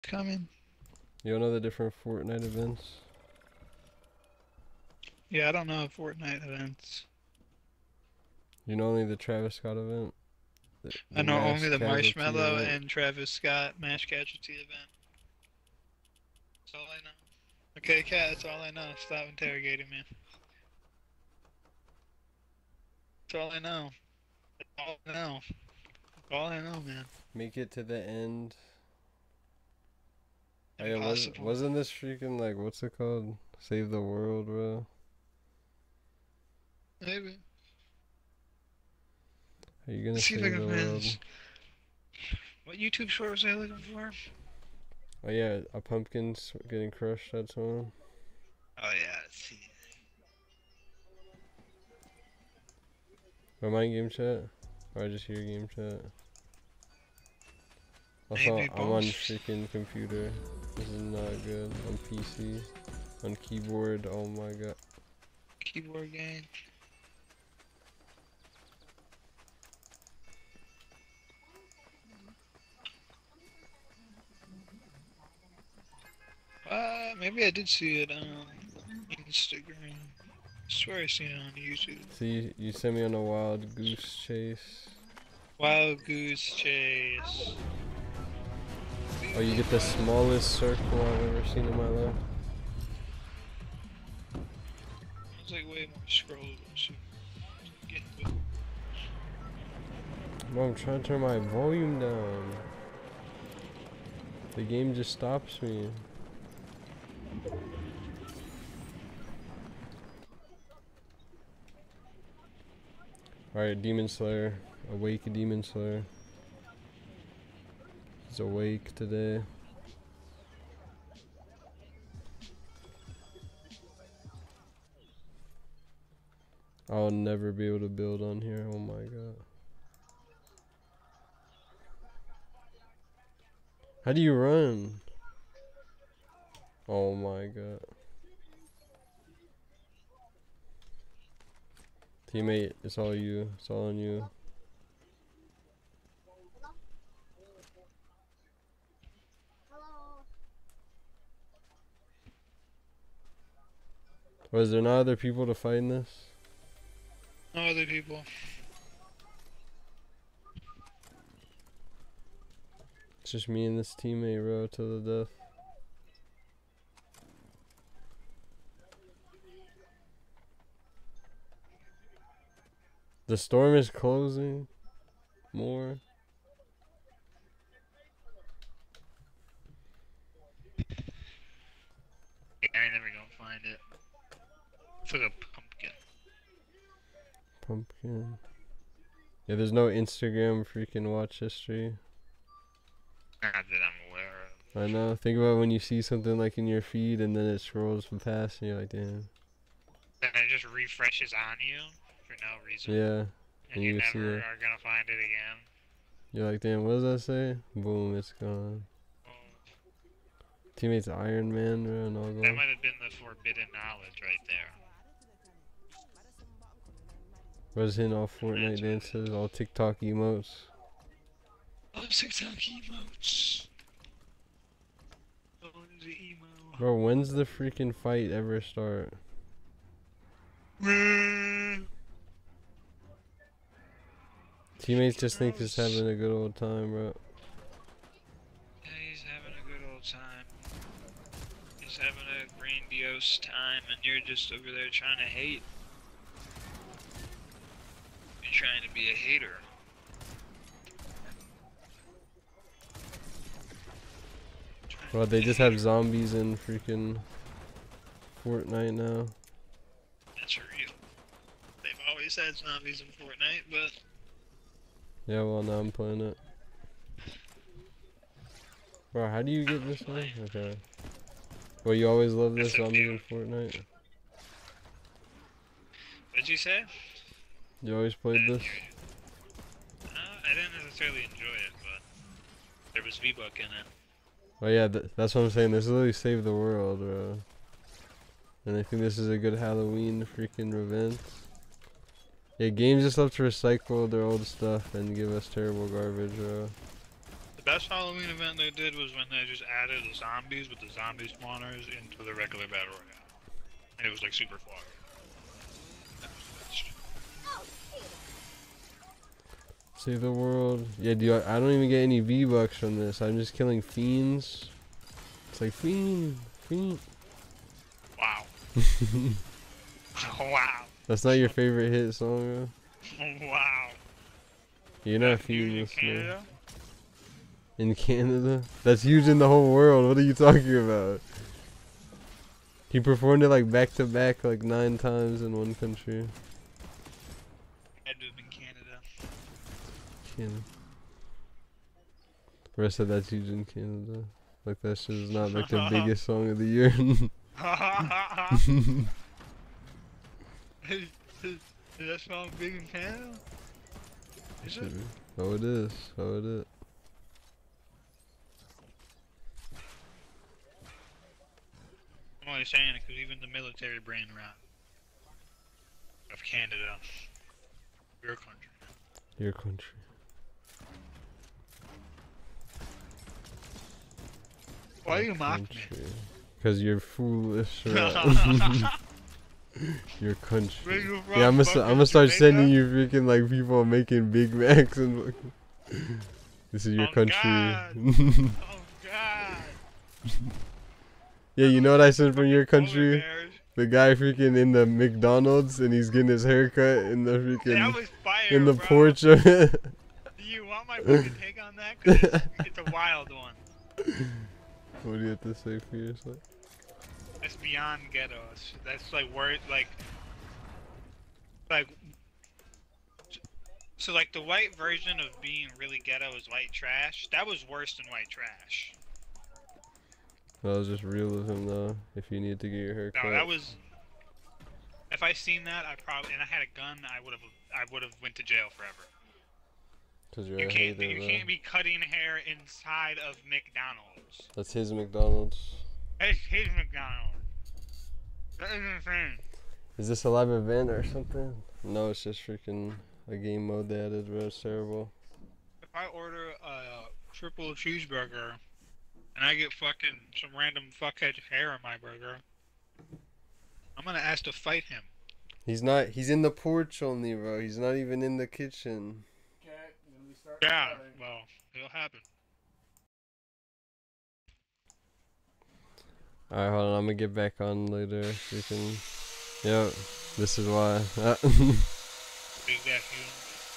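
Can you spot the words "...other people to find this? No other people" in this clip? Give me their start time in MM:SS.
02:34.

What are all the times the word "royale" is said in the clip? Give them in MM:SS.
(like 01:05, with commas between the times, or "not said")
05:02.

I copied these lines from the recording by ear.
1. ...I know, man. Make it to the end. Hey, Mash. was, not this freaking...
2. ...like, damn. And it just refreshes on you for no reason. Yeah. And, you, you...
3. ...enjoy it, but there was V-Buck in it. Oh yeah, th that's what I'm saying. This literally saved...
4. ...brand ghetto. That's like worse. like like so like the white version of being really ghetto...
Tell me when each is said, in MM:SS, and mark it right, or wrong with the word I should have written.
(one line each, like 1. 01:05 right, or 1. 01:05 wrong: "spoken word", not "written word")
1. 00:26 wrong: "Impossible", not "Mash"
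2. 03:18 right
3. 04:41 right
4. 06:47 wrong: "beyond", not "brand".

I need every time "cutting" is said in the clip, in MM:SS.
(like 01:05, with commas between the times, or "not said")
07:11.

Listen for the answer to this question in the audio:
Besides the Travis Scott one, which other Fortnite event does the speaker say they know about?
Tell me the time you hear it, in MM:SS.
00:11.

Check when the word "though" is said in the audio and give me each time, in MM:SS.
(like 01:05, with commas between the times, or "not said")
05:23, 07:01.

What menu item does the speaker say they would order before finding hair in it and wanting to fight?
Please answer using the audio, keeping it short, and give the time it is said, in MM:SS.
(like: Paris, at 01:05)
Triple cheeseburger, at 07:27.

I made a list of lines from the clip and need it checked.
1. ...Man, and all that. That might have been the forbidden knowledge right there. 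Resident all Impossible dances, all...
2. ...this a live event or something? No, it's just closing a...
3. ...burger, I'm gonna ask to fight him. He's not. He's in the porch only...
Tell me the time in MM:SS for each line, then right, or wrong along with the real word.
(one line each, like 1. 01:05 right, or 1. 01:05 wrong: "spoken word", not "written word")
1. 03:31 wrong: "Fortnite", not "Impossible"
2. 07:20 wrong: "freaking", not "closing"
3. 07:31 right.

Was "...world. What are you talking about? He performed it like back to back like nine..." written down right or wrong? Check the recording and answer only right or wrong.
right.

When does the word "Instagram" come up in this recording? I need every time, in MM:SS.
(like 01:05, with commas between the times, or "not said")
01:19, 03:09.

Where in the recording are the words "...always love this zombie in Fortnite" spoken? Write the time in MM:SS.
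04:32.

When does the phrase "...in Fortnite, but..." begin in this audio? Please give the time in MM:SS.
04:23.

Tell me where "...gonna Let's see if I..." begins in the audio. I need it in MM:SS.
00:40.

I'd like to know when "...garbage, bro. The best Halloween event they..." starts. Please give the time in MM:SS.
04:55.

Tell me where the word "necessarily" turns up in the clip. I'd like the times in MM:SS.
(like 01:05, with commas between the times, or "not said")
04:40.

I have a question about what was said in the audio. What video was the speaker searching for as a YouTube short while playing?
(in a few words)
A pumpkin getting crushed.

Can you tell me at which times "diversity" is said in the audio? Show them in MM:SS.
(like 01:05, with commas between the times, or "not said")
not said.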